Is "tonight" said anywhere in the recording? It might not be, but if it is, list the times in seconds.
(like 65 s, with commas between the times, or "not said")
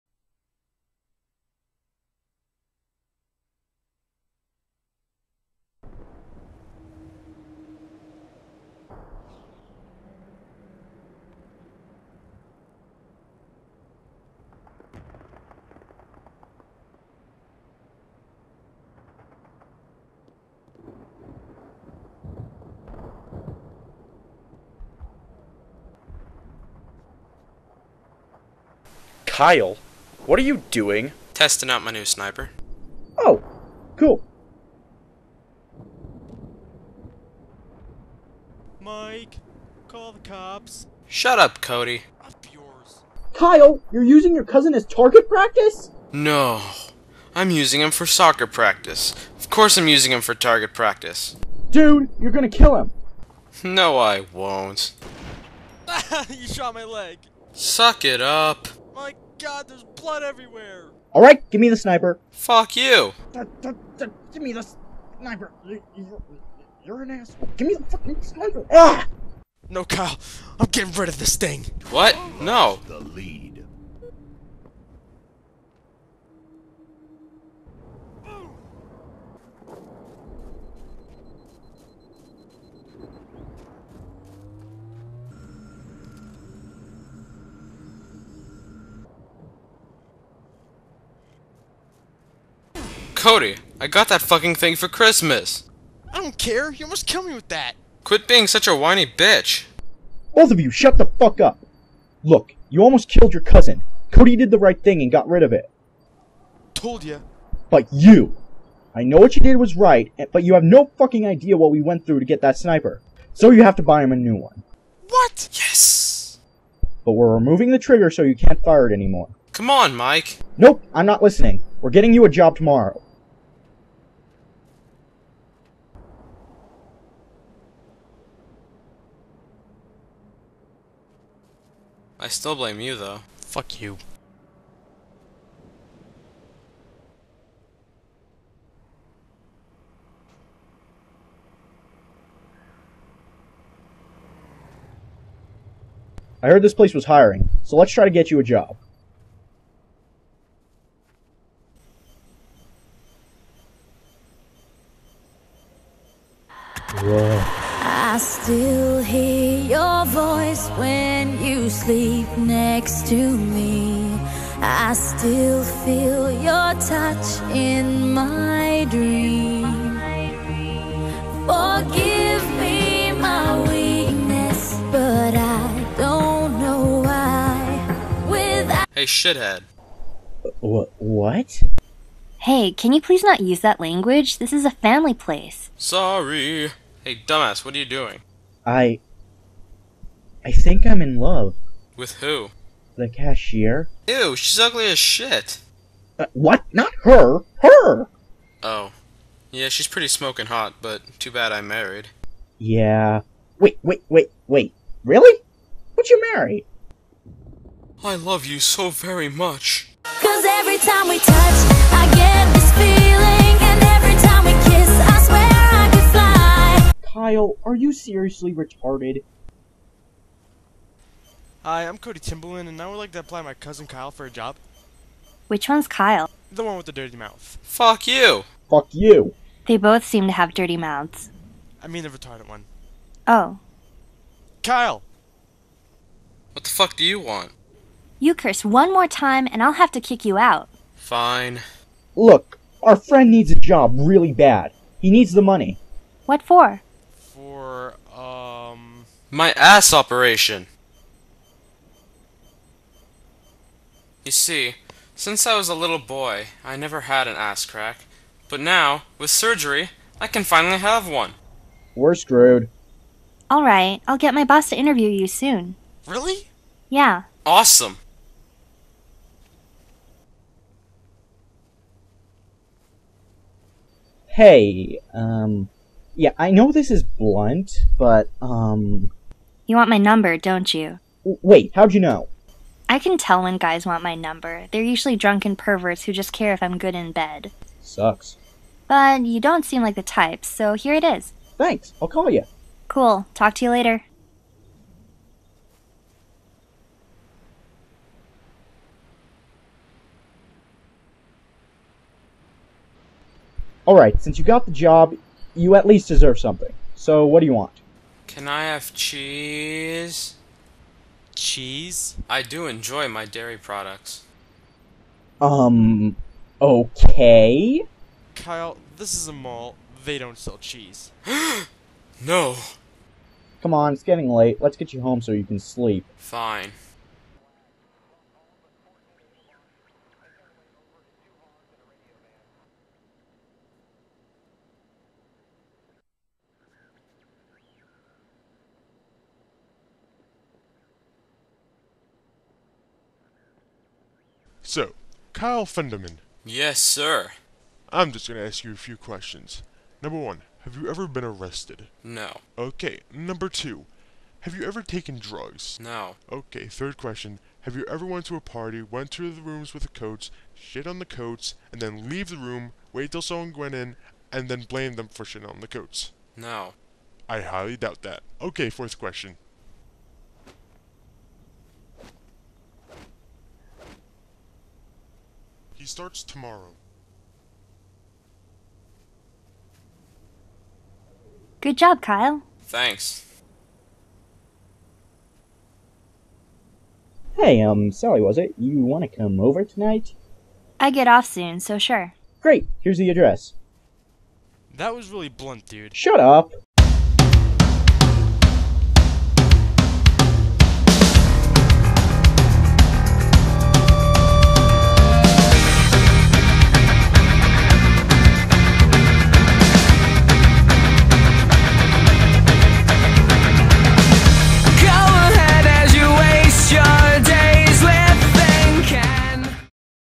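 389 s.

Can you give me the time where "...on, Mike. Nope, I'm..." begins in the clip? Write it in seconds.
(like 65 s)
119 s.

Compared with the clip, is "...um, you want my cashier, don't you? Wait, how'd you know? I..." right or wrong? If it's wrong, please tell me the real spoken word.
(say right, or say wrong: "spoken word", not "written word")
wrong: "number", not "cashier".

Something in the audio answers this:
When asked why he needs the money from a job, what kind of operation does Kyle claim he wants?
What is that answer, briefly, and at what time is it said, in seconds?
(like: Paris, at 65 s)
Ass operation, at 249 s.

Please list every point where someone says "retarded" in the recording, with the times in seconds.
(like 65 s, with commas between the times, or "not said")
218 s, 232 s.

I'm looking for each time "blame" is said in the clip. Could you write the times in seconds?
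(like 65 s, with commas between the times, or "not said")
132 s, 364 s.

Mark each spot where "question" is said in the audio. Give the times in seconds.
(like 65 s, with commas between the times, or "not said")
348 s, 356 s, 368 s.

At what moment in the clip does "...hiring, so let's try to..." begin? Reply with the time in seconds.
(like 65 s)
147 s.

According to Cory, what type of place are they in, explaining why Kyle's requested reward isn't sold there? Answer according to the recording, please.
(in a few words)
A mall.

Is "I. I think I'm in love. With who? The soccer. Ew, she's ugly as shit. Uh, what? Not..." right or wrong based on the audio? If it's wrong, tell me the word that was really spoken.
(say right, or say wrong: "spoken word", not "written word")
wrong: "cashier", not "soccer".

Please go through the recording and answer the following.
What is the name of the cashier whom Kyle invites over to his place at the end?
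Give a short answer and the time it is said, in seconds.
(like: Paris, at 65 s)
Sally, at 387 s.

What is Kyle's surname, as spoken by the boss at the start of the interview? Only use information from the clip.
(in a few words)
Fenderman.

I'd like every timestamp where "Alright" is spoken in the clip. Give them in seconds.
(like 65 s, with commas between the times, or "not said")
61 s, 263 s, 303 s.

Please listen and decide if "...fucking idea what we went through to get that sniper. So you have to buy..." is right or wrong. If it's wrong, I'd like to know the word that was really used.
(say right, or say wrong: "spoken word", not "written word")
right.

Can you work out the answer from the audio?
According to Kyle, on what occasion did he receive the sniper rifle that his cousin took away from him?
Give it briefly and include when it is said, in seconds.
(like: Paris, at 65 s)
Christmas, at 94 s.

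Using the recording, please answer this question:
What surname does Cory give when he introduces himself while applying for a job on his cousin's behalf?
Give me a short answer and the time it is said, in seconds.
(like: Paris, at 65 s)
Timberland, at 222 s.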